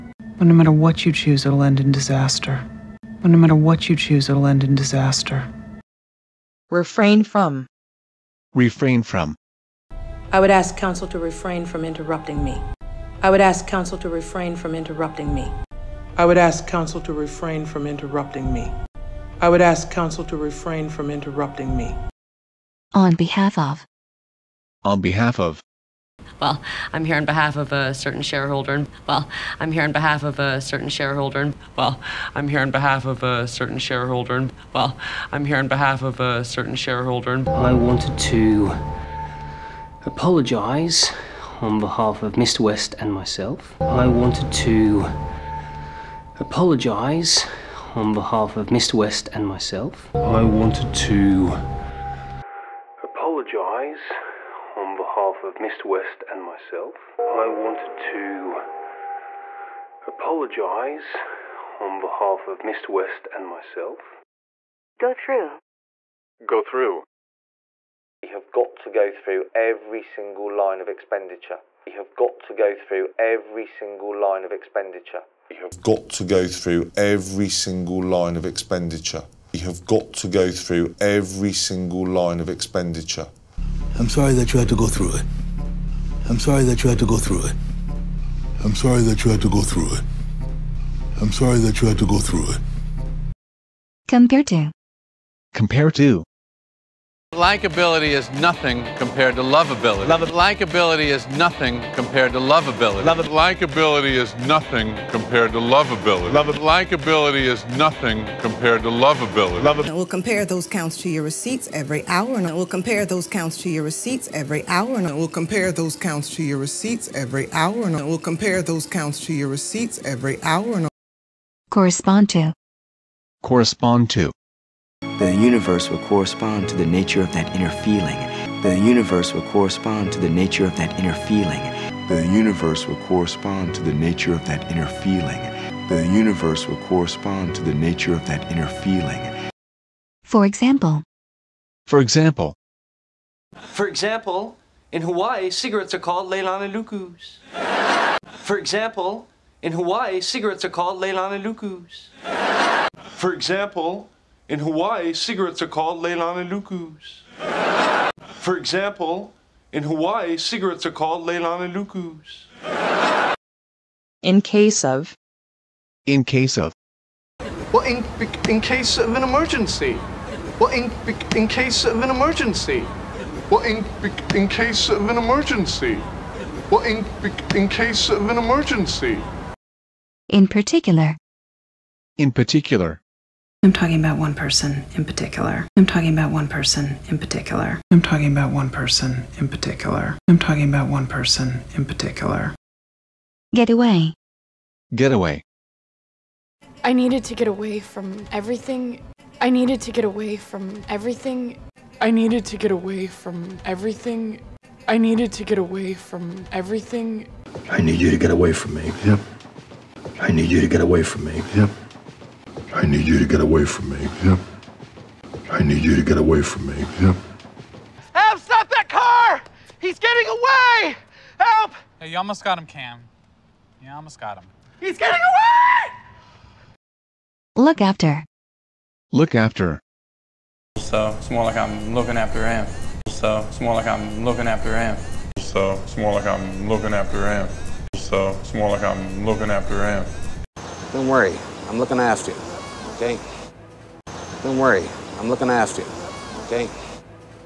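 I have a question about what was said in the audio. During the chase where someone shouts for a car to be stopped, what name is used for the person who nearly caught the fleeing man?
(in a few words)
Cam.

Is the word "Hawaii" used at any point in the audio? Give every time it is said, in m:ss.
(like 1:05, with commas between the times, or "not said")
2:25, 2:29, 2:34, 2:39.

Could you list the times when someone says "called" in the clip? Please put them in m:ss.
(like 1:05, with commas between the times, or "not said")
2:26, 2:30, 2:35, 2:40.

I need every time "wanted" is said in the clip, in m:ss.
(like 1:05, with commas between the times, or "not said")
0:37, 0:44, 0:50, 0:57.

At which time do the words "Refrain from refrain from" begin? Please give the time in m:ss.
0:06.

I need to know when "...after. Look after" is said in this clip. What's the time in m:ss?
3:47.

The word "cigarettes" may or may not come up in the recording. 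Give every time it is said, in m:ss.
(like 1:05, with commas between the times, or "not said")
2:25, 2:30, 2:35, 2:40.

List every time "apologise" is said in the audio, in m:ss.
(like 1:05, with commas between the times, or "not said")
0:40, 0:46, 0:53, 1:00.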